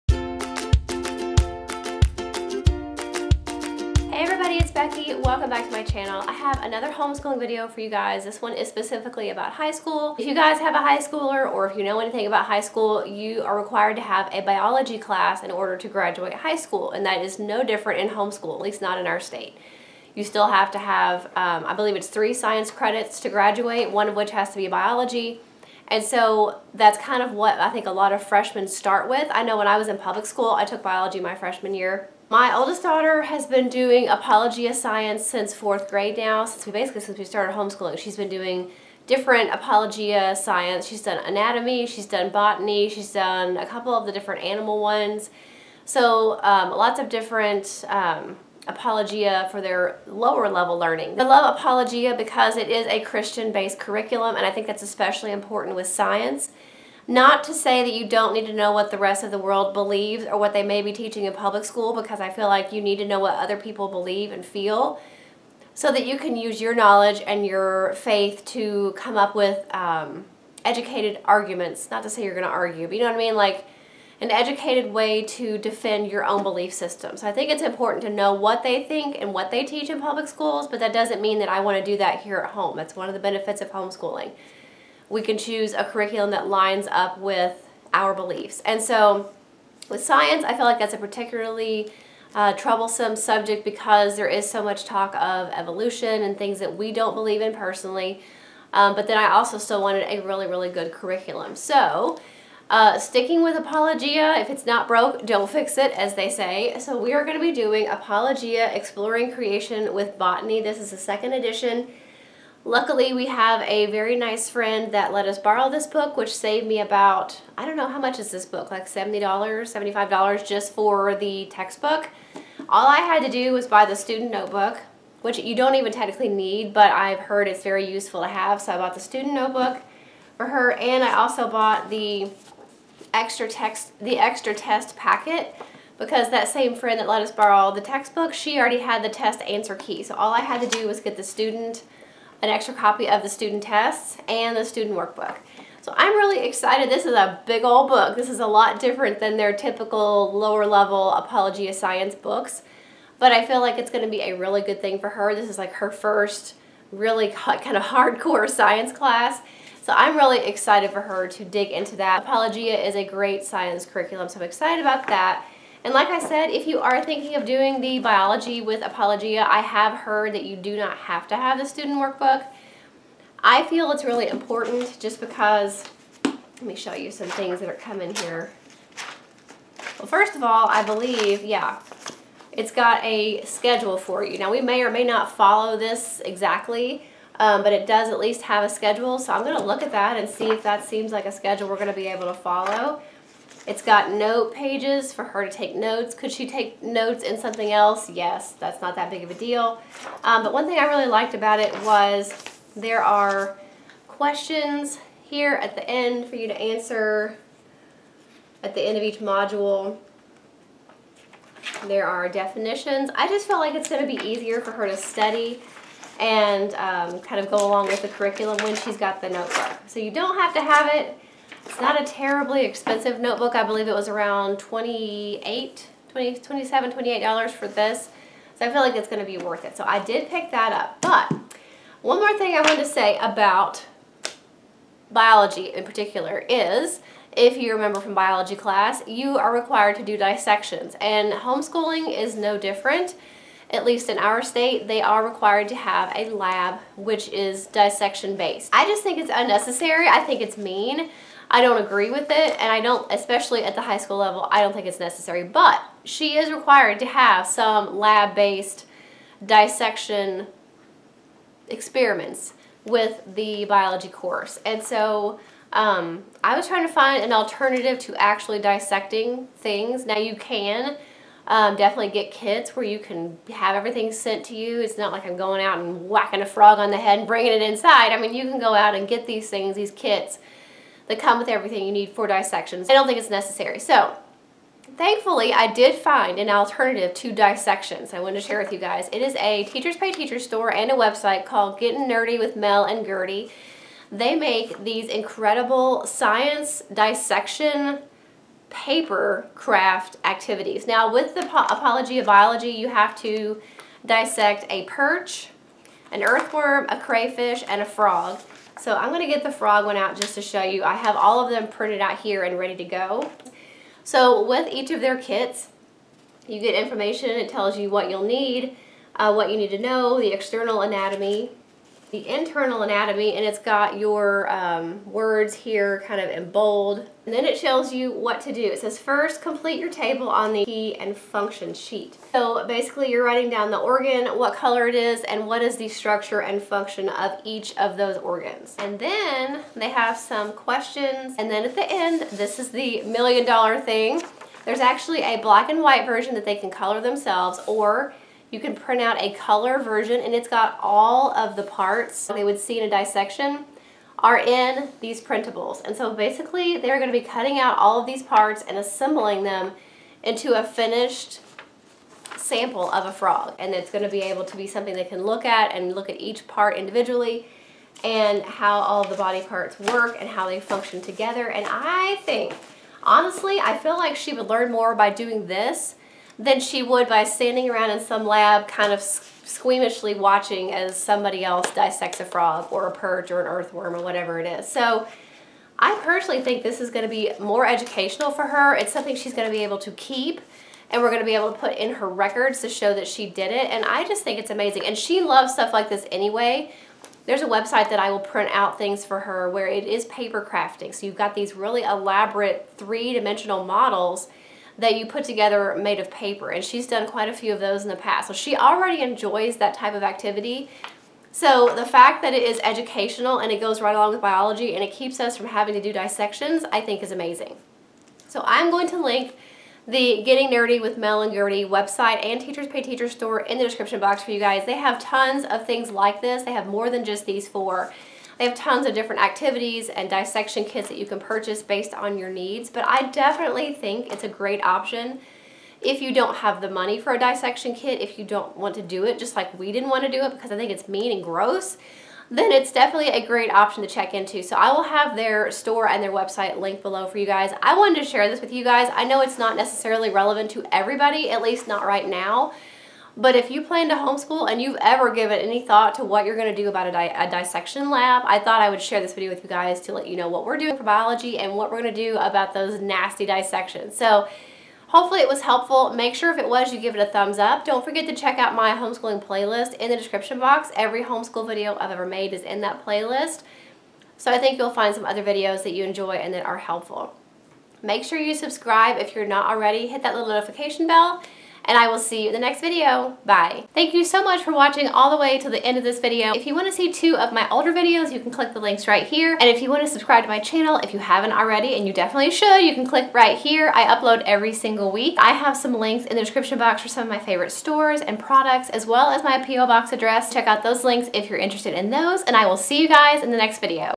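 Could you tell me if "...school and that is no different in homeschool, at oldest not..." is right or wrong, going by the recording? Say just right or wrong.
wrong.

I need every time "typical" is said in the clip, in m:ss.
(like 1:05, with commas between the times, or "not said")
2:29.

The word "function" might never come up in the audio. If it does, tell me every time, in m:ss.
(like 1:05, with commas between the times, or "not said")
5:31, 5:36, 6:10.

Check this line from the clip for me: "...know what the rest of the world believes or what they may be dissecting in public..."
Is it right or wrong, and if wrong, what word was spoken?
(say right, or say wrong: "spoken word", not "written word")
wrong: "teaching", not "dissecting".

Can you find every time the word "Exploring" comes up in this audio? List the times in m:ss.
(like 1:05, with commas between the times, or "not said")
1:48.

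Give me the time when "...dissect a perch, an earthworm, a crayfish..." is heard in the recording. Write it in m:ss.
5:04.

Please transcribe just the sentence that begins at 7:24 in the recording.
So I will have their store and their website linked below for you guys.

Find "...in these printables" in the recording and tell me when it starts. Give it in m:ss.
5:54.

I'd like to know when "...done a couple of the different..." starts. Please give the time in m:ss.
0:43.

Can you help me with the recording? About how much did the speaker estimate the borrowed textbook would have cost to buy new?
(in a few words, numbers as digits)
$70-$75.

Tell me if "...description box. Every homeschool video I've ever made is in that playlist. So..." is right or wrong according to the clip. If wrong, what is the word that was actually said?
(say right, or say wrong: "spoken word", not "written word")
right.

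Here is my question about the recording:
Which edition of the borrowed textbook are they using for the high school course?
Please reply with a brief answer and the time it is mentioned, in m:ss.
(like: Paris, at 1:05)
second edition, at 1:50.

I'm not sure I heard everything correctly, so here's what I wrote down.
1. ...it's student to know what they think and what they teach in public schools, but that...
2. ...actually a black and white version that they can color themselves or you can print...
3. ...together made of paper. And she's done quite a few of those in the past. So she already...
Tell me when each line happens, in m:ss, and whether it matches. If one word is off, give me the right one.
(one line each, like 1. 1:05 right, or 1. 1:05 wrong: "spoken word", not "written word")
1. 1:17 wrong: "important", not "student"
2. 5:44 right
3. 6:45 right.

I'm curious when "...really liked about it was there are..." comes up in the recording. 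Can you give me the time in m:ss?
3:20.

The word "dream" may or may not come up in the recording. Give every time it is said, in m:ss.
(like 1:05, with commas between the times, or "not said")
not said.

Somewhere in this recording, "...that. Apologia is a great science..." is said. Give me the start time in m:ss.
2:41.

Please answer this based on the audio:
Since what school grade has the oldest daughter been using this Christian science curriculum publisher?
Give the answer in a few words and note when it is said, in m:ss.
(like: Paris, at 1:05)
fourth grade, at 0:35.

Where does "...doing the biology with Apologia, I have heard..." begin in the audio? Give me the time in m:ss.
2:47.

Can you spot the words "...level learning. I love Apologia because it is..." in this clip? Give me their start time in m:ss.
0:50.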